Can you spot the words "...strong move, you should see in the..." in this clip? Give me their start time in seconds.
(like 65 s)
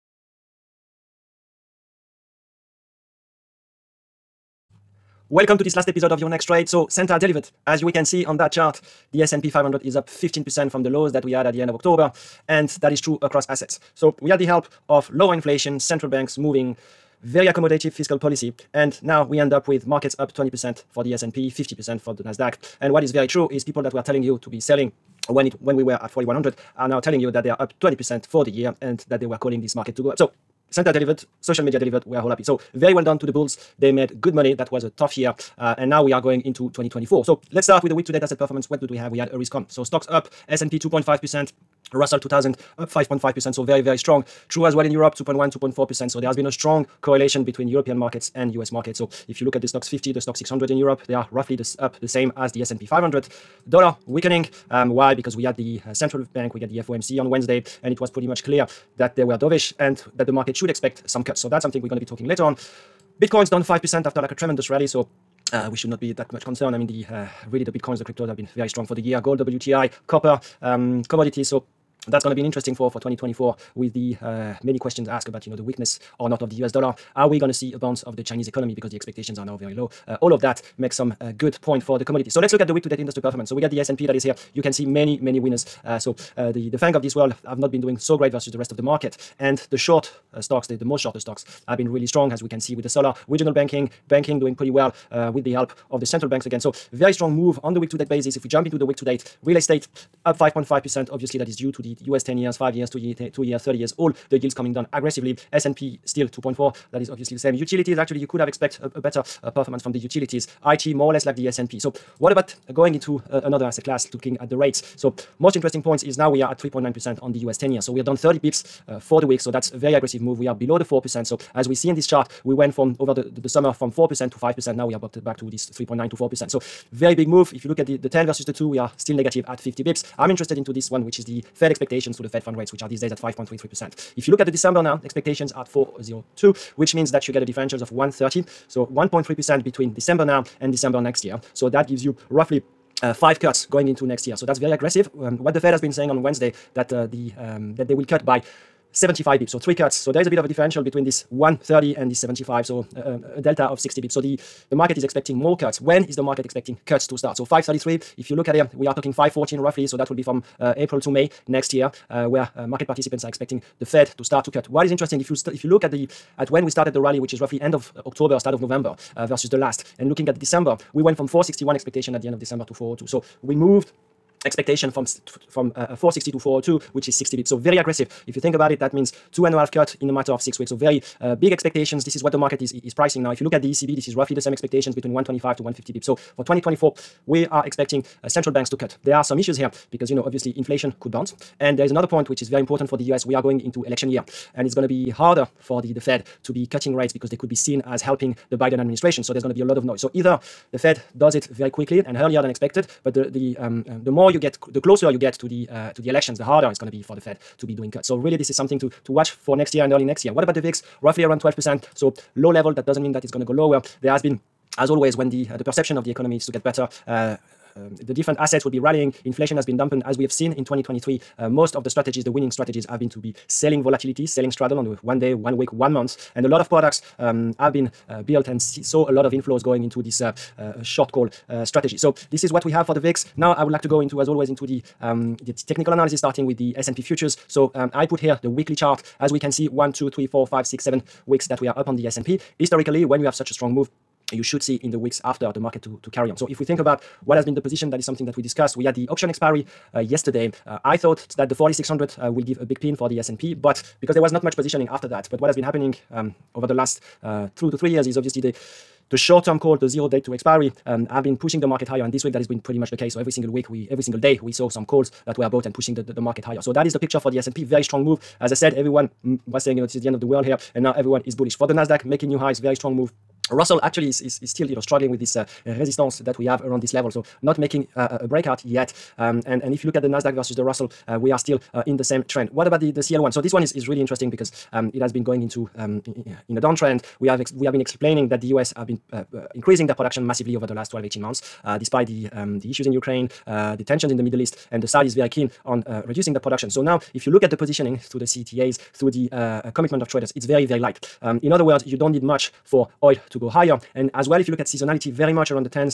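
243 s.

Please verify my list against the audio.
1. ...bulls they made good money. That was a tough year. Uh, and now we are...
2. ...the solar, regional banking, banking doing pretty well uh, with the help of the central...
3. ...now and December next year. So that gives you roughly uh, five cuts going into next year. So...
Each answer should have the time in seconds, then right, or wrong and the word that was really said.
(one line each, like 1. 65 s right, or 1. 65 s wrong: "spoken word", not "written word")
1. 33 s right
2. 92 s right
3. 140 s right.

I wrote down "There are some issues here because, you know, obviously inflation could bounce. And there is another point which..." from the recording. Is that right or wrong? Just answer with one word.
right.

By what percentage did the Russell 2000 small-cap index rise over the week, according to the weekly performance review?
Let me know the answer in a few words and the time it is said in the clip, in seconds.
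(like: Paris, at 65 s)
5.5%, at 41 s.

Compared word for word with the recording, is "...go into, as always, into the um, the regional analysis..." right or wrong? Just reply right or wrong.
wrong.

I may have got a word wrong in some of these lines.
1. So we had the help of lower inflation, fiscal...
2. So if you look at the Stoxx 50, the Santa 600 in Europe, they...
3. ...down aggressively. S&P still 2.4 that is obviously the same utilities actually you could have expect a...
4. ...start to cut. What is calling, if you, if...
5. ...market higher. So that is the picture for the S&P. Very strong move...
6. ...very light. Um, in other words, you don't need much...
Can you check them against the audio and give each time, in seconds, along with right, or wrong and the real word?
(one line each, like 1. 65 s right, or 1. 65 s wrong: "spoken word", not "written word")
1. 13 s wrong: "central", not "fiscal"
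2. 48 s wrong: "Stoxx", not "Santa"
3. 104 s right
4. 164 s wrong: "interesting", not "calling"
5. 266 s right
6. 300 s right.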